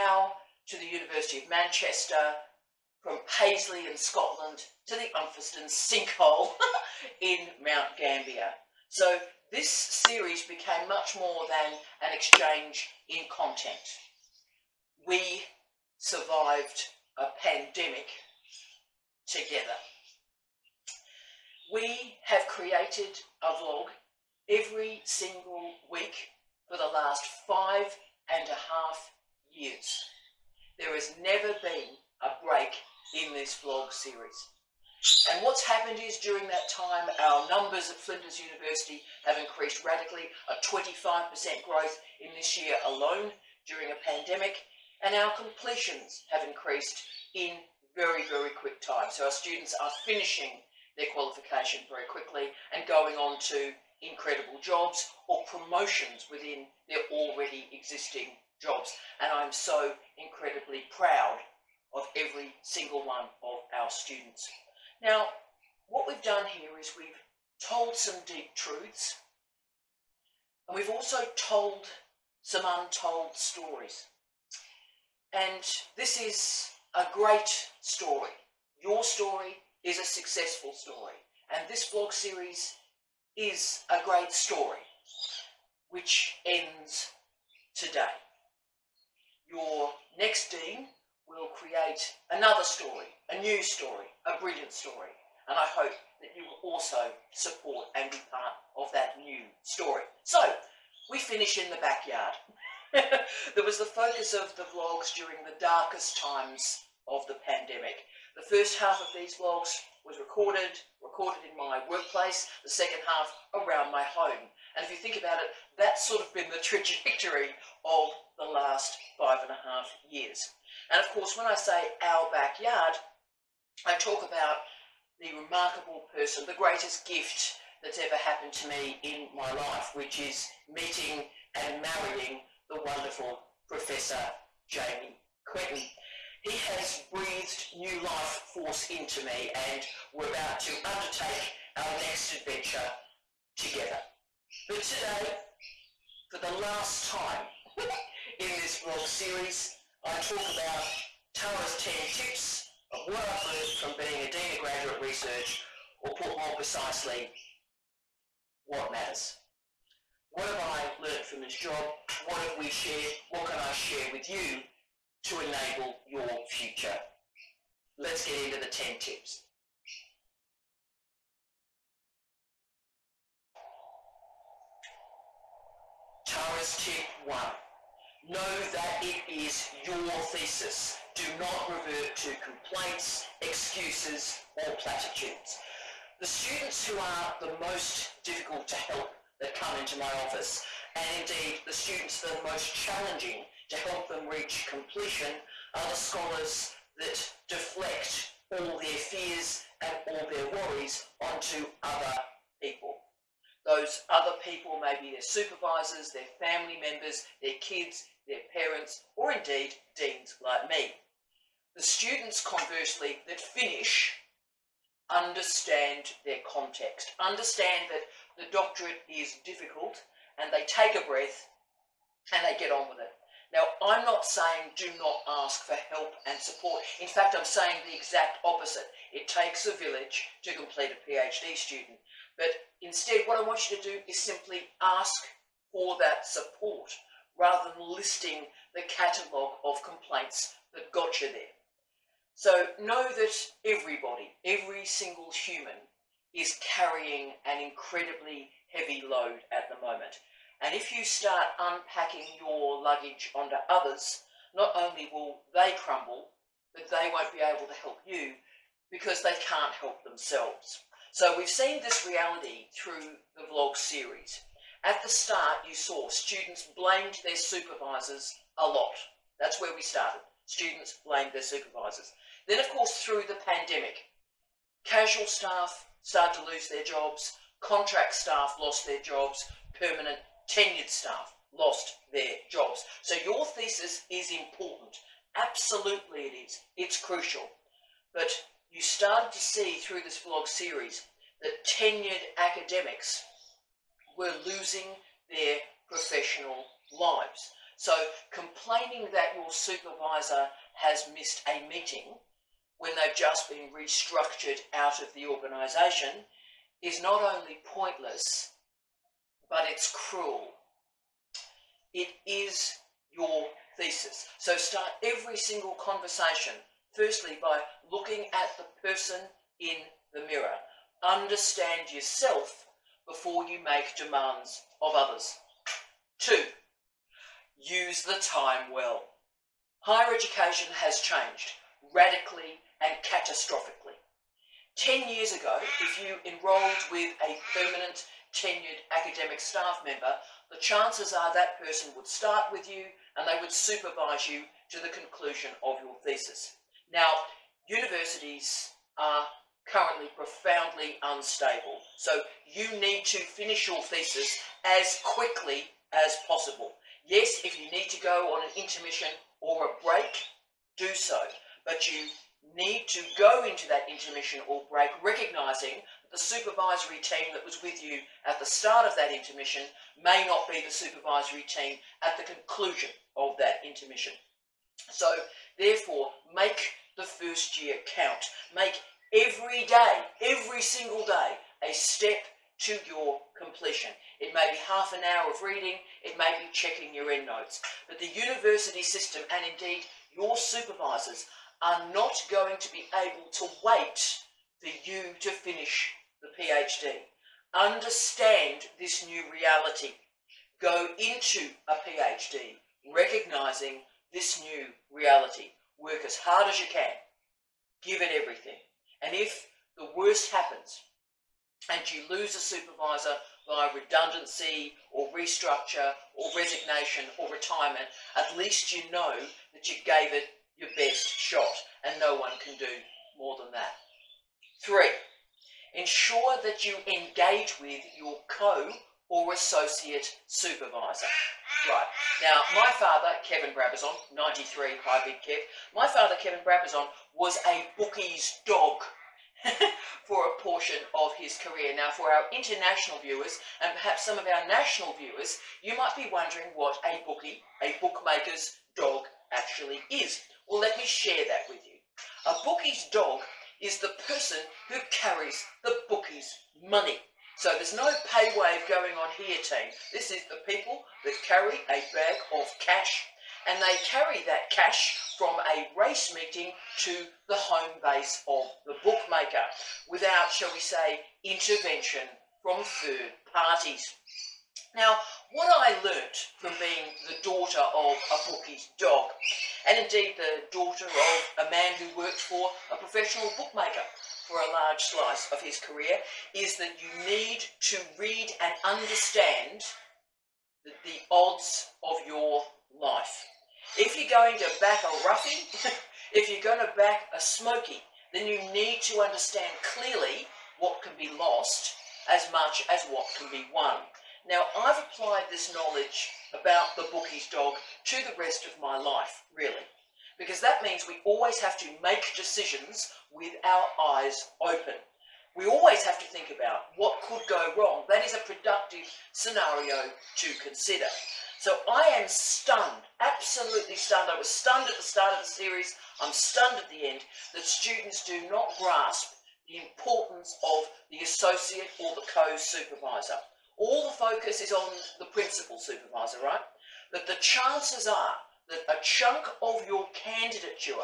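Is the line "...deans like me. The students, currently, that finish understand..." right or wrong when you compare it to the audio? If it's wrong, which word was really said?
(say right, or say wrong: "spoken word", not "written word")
wrong: "conversely", not "currently".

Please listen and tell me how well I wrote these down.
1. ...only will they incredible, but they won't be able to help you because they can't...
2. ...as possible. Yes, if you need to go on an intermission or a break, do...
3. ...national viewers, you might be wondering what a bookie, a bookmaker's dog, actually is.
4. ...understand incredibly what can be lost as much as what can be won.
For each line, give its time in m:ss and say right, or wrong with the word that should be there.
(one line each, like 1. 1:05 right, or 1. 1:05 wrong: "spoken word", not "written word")
1. 4:14 wrong: "crumble", not "incredible"
2. 5:55 right
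3. 7:24 right
4. 8:19 wrong: "clearly", not "incredibly".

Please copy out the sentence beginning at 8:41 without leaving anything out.
So I am stunned, absolutely stunned.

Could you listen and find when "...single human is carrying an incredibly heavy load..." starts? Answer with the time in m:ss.
4:04.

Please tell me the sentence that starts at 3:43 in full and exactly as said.
Now, I'm not saying do not ask for help and support.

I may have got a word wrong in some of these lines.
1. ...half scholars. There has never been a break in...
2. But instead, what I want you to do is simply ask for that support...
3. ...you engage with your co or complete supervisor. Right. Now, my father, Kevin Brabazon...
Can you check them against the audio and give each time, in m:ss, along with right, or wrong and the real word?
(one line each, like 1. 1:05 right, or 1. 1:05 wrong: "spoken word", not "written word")
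1. 0:28 wrong: "years", not "scholars"
2. 3:52 right
3. 7:06 wrong: "associate", not "complete".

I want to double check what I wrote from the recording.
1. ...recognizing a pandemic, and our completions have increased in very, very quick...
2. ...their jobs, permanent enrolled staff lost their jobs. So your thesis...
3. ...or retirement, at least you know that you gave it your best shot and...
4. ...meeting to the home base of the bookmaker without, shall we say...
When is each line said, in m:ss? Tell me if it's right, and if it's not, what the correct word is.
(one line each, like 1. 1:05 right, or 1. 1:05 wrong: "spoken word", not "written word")
1. 0:43 wrong: "during", not "recognizing"
2. 4:38 wrong: "tenured", not "enrolled"
3. 6:57 right
4. 7:46 right.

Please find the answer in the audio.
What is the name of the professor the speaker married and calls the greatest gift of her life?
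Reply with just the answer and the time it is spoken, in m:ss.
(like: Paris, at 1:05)
Jamie Quinton, at 2:14.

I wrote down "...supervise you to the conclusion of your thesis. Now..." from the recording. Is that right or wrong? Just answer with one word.
right.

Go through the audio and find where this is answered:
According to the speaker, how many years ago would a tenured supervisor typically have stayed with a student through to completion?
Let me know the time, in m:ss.
5:34.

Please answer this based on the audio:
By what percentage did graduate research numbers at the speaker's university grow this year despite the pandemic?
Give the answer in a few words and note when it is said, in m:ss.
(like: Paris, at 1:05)
25%, at 0:40.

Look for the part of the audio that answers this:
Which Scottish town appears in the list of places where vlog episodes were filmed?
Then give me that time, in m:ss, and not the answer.
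0:03.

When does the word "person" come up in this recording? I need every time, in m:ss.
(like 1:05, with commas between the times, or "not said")
2:06, 5:18, 5:41, 7:34.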